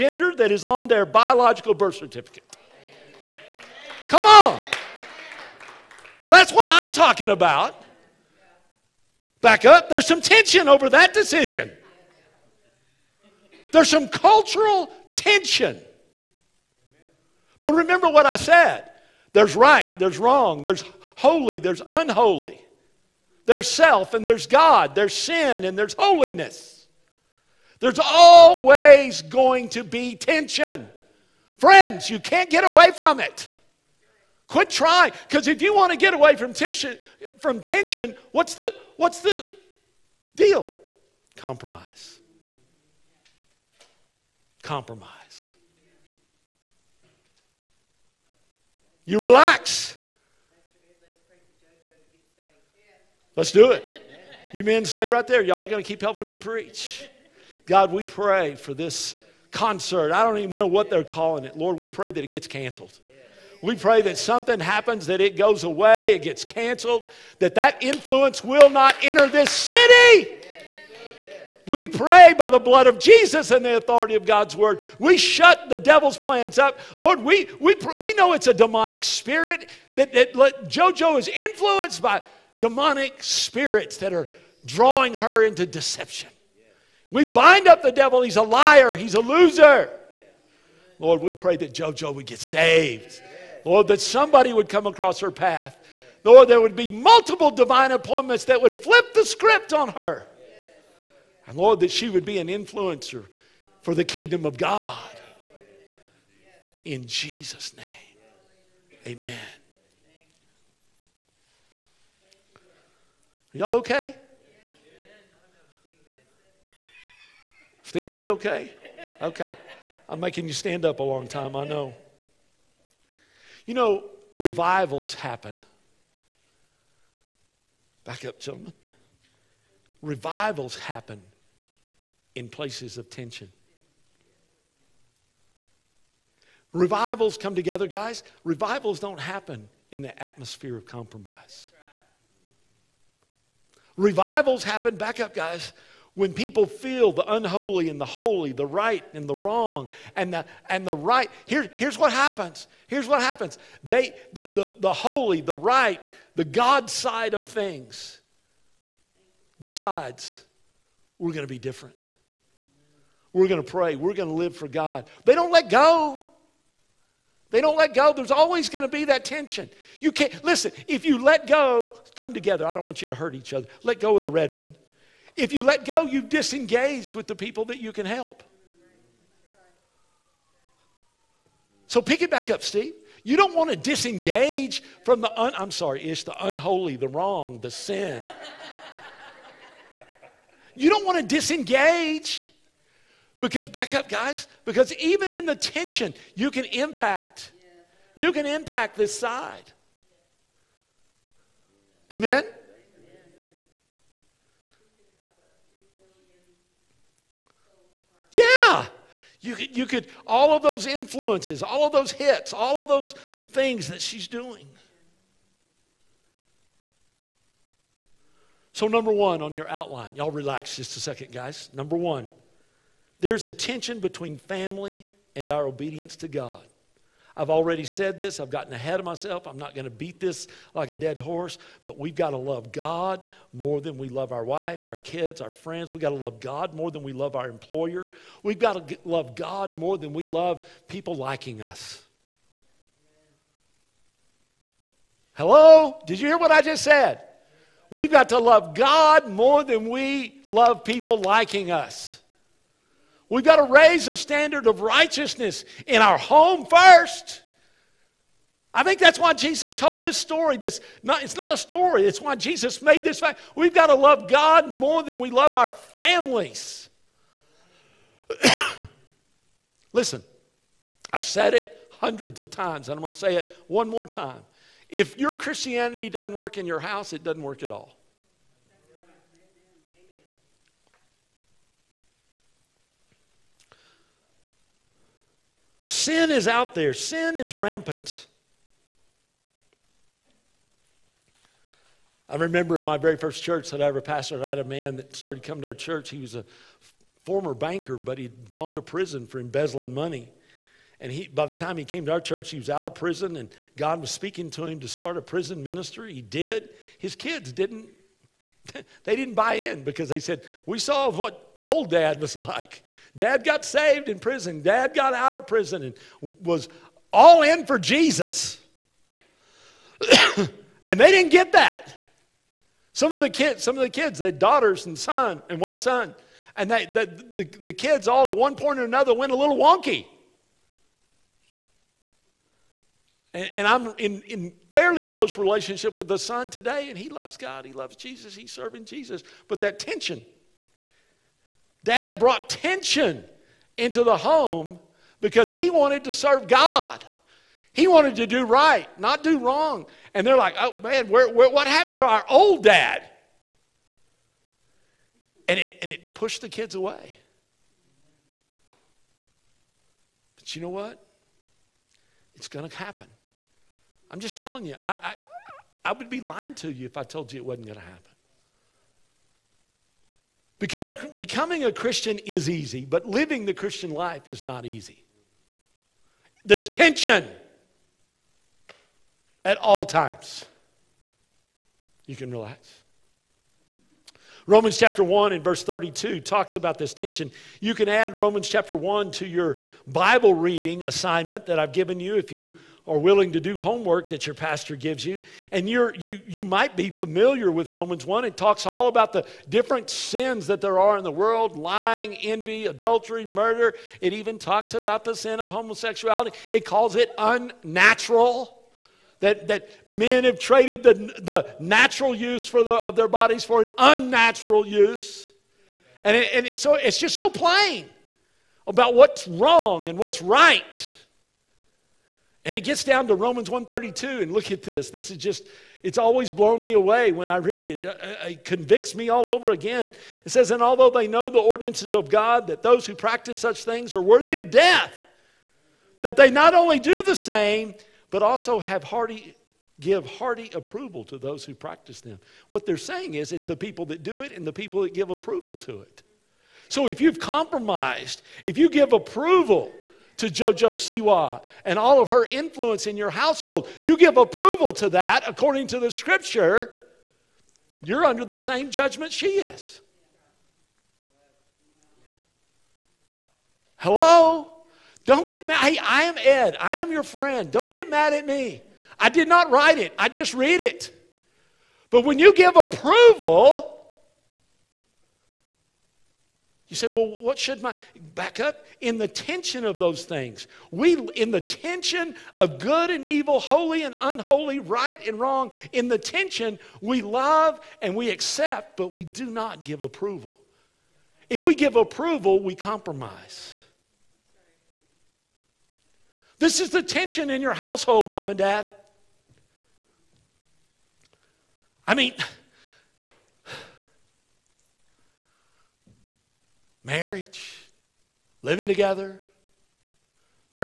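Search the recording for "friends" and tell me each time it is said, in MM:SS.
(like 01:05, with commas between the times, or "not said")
00:31, 03:55, 07:47.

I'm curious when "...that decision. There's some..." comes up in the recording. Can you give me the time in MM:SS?
00:10.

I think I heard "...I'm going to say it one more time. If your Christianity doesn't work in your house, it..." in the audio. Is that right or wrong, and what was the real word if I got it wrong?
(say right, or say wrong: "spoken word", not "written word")
right.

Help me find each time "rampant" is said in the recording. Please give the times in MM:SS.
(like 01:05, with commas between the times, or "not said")
04:47.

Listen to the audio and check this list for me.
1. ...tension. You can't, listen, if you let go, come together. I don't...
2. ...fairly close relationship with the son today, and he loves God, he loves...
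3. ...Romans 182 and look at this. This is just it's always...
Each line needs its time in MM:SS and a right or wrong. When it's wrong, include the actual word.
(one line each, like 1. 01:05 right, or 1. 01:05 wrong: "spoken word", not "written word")
1. 02:49 right
2. 05:34 right
3. 07:03 wrong: "132", not "182".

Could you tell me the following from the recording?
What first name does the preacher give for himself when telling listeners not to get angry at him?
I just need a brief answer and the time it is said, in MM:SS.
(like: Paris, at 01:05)
Ed, at 07:45.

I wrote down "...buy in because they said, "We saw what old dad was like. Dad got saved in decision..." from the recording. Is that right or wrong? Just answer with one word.
wrong.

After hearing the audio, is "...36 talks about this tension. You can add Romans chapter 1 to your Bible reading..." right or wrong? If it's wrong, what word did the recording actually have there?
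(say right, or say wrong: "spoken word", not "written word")
wrong: "32", not "36".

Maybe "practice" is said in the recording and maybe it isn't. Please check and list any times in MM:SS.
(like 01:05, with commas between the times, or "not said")
07:12, 07:21.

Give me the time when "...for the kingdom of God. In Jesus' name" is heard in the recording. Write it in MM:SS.
01:43.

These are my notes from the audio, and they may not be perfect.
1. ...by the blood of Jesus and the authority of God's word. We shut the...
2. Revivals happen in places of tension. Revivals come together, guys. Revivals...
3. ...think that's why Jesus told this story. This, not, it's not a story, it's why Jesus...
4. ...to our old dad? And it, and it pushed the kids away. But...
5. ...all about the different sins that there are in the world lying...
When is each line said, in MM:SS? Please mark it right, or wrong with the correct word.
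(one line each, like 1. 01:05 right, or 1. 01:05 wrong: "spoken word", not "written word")
1. 01:12 right
2. 02:10 right
3. 04:18 right
4. 05:51 right
5. 06:38 right.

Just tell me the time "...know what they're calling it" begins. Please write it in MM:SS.
01:00.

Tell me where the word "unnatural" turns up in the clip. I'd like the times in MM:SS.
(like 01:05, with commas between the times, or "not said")
06:47, 06:53.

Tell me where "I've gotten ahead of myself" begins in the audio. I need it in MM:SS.
03:48.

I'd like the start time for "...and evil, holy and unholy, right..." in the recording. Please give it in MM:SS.
08:02.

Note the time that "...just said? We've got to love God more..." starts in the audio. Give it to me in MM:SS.
04:06.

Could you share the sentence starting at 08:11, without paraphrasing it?
If we give approval, we compromise.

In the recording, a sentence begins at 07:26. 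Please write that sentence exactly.
So if you've compromised, if you give approval, to JoJo Siwa and all of her influence in your household.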